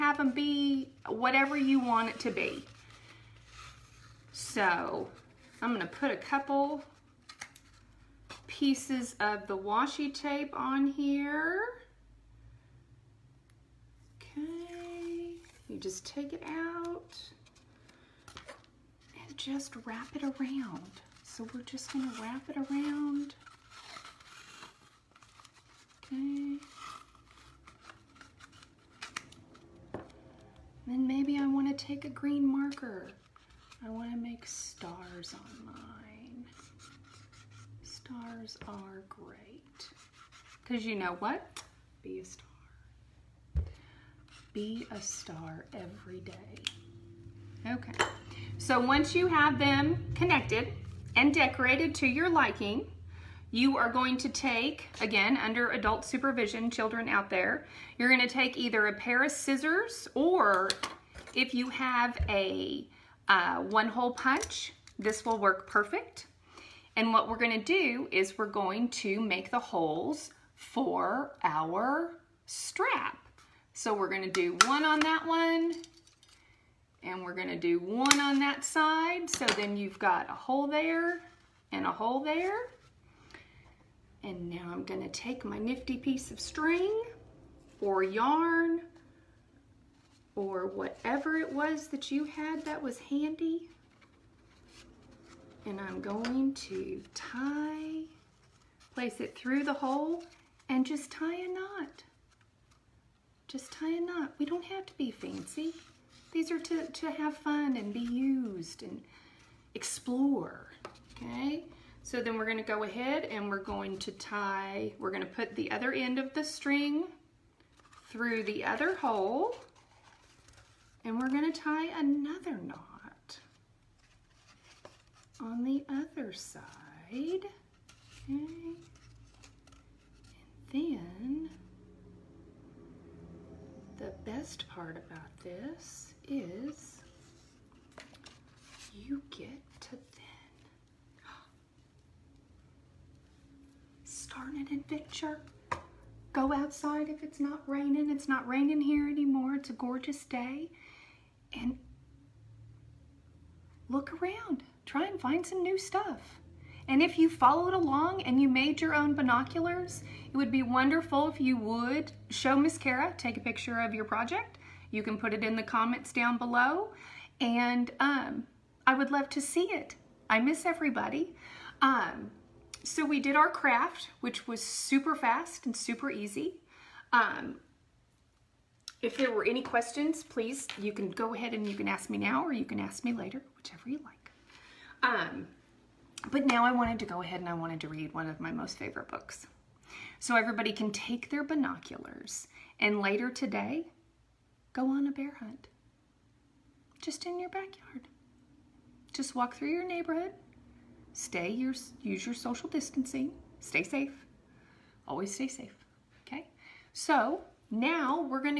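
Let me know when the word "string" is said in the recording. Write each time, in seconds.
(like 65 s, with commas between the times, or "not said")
86 s, 116 s.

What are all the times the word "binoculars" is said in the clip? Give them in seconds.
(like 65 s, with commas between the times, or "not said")
159 s, 191 s.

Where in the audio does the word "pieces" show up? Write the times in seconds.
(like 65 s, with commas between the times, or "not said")
8 s, 85 s.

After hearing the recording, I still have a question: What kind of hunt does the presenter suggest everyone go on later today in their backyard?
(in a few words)
A bear hunt.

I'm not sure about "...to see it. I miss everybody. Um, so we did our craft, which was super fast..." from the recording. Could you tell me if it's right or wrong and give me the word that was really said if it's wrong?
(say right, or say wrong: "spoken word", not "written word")
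right.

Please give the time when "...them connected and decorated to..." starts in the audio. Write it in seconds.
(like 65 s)
49 s.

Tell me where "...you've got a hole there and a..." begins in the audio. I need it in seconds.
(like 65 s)
79 s.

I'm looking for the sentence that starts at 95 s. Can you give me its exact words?
And I'm going to tie, place it through the hole and just tie a knot.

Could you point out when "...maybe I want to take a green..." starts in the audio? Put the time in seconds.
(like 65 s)
31 s.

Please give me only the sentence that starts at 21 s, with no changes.
So we're just gonna wrap it around.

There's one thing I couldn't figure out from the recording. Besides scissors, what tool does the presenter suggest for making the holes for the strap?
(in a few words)
One hole punch.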